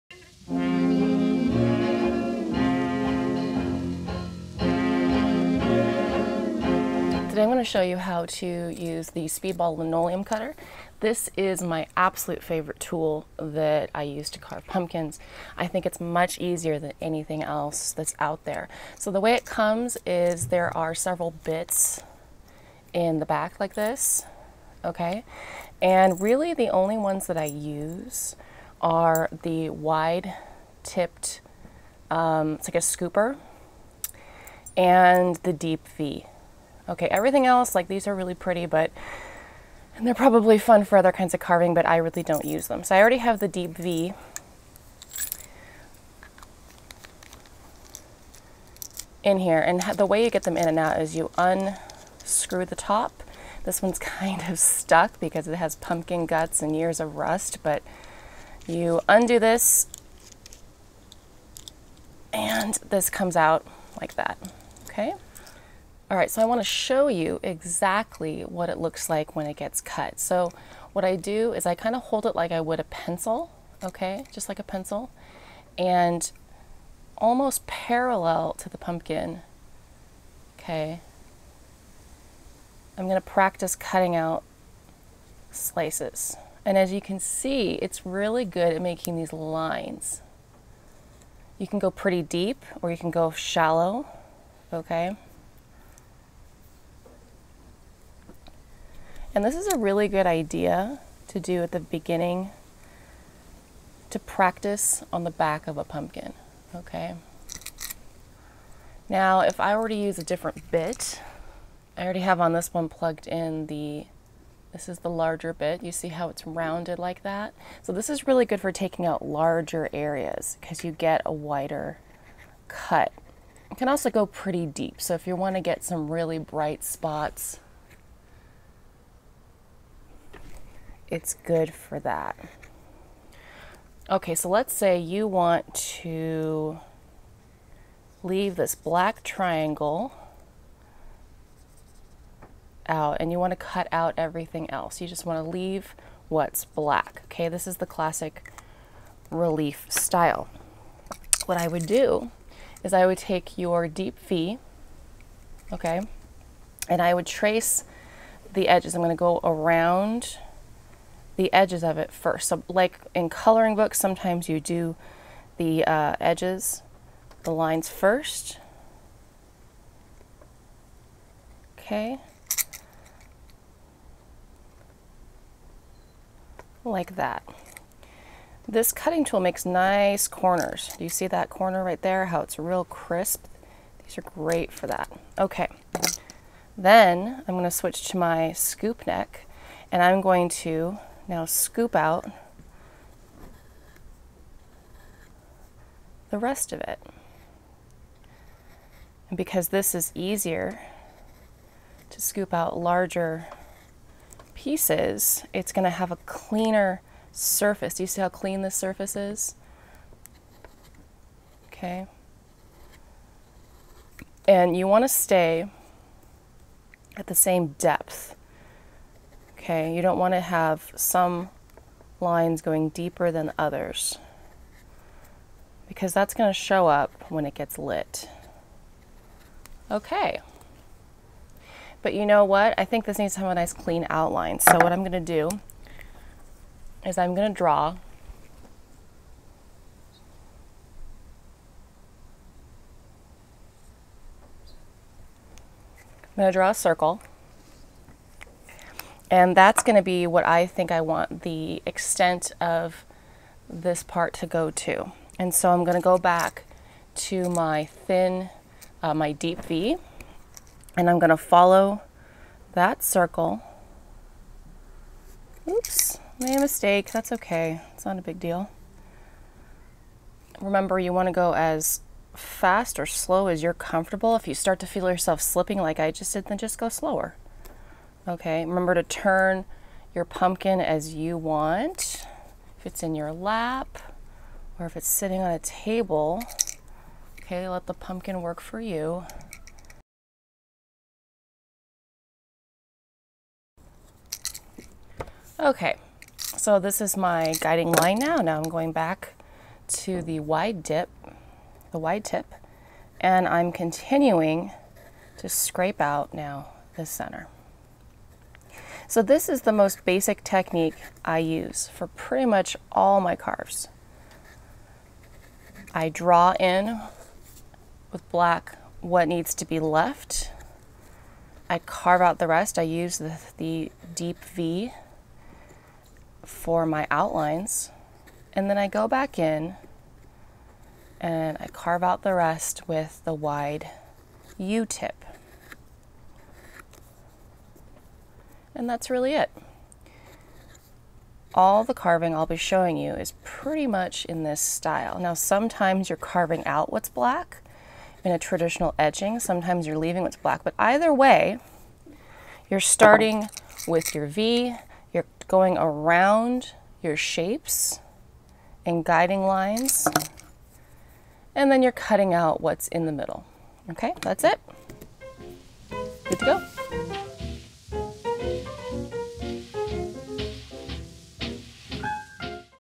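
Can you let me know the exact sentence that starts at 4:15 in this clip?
And so I'm going to go back to my thin, uh, my deep V, and I'm going to follow that circle.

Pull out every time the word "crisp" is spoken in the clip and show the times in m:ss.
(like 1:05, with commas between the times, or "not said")
3:02.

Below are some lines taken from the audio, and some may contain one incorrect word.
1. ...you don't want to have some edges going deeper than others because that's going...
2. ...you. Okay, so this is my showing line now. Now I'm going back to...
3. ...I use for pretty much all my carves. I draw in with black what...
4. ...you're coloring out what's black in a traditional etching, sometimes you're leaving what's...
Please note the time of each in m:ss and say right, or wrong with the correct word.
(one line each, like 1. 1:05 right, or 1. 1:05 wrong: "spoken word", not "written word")
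1. 3:39 wrong: "lines", not "edges"
2. 4:48 wrong: "guiding", not "showing"
3. 5:11 right
4. 5:46 wrong: "carving", not "coloring".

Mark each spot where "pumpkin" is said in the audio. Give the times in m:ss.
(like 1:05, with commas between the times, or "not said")
0:14, 0:55, 1:18, 1:45, 4:40, 4:47.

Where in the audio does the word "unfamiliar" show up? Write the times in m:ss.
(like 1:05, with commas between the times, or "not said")
not said.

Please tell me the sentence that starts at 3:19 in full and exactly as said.
And because this is easier to scoop out larger pieces, it's going to have a cleaner surface.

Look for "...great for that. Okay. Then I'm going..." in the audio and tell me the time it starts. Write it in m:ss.
3:04.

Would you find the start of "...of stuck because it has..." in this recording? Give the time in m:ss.
0:54.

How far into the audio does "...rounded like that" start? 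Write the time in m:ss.
1:56.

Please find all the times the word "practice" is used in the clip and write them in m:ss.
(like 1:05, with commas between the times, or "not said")
1:23, 1:44.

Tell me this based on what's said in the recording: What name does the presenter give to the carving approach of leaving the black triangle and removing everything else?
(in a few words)
classic relief style.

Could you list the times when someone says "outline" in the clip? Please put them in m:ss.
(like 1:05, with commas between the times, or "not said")
3:54, 5:27.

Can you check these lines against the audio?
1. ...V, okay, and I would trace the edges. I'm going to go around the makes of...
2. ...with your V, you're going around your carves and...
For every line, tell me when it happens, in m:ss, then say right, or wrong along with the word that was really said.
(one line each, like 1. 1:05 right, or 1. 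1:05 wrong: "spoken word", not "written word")
1. 2:34 wrong: "edges", not "makes"
2. 5:53 wrong: "shapes", not "carves".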